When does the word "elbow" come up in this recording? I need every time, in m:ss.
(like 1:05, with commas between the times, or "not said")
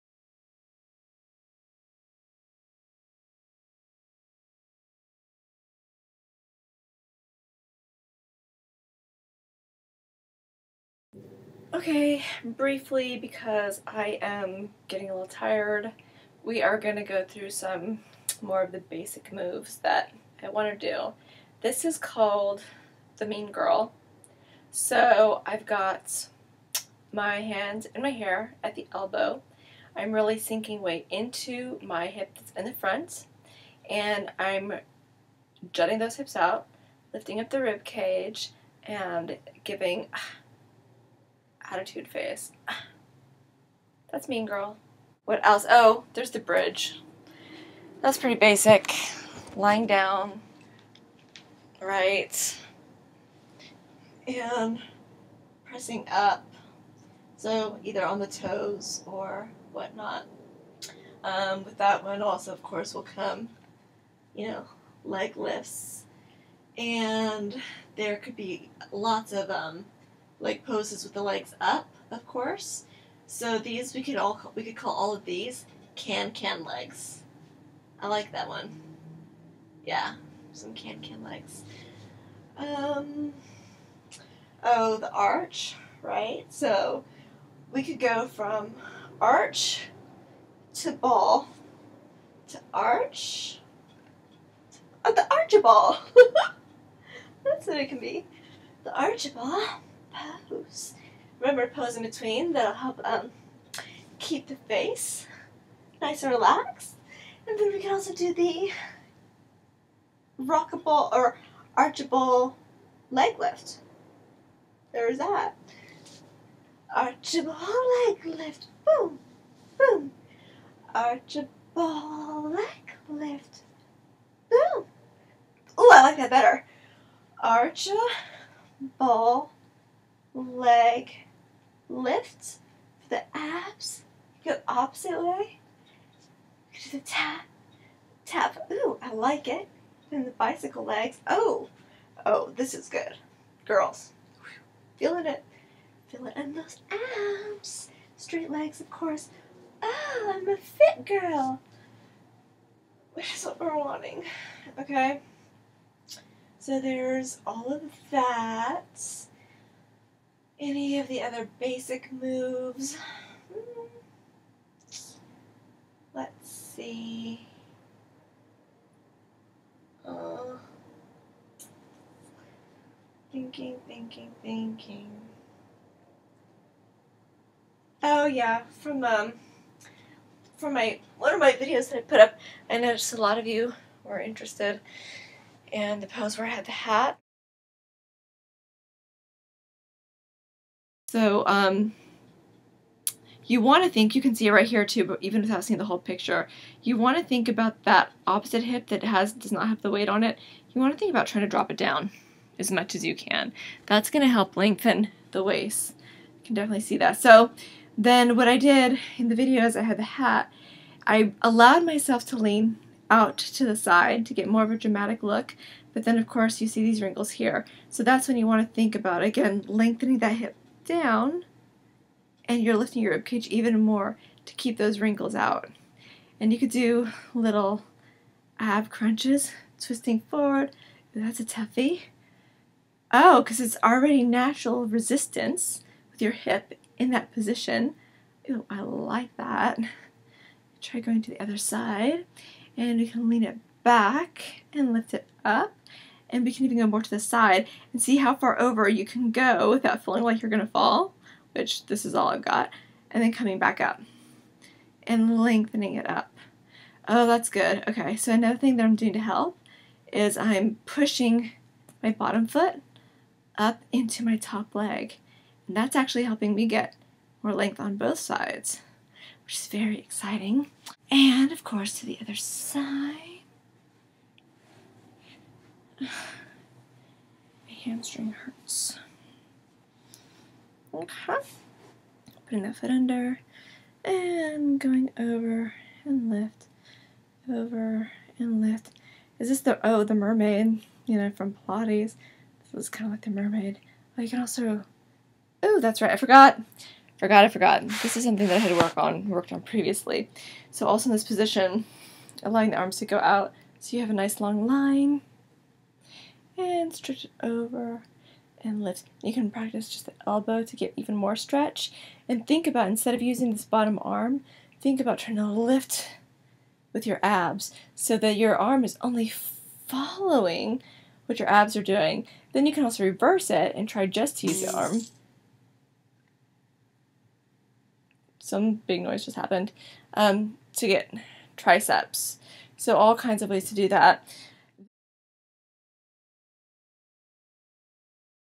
0:28, 5:10.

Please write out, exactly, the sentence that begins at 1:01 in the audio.
Um, with that one also, of course, will come, you know, leg lifts.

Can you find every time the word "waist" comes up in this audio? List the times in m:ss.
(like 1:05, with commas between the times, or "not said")
3:25.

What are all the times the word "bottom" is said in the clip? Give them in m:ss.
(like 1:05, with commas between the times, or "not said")
4:22, 5:13.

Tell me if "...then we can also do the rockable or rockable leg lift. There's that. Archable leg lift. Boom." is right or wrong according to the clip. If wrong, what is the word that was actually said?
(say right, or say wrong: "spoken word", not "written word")
wrong: "archable", not "rockable".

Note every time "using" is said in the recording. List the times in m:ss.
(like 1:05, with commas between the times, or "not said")
5:13.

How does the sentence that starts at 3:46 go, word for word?
And you could do little ab crunches, twisting forward.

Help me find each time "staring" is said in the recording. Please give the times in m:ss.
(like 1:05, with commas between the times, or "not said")
not said.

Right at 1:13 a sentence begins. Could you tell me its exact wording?
So these we could all we could call all of these can can legs.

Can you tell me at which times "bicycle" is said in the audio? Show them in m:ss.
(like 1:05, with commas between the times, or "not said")
2:20.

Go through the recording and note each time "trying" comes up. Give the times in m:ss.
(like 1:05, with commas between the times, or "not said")
3:21, 5:15.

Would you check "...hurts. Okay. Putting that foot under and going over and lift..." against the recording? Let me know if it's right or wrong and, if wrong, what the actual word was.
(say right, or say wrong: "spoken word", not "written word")
right.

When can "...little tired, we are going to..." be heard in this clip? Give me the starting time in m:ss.
0:15.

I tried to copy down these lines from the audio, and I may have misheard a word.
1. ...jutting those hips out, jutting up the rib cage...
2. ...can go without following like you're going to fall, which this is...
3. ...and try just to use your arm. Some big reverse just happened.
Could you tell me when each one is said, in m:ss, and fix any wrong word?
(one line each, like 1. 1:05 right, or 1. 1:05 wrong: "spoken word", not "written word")
1. 0:35 wrong: "lifting", not "jutting"
2. 4:09 wrong: "feeling", not "following"
3. 5:23 wrong: "noise", not "reverse".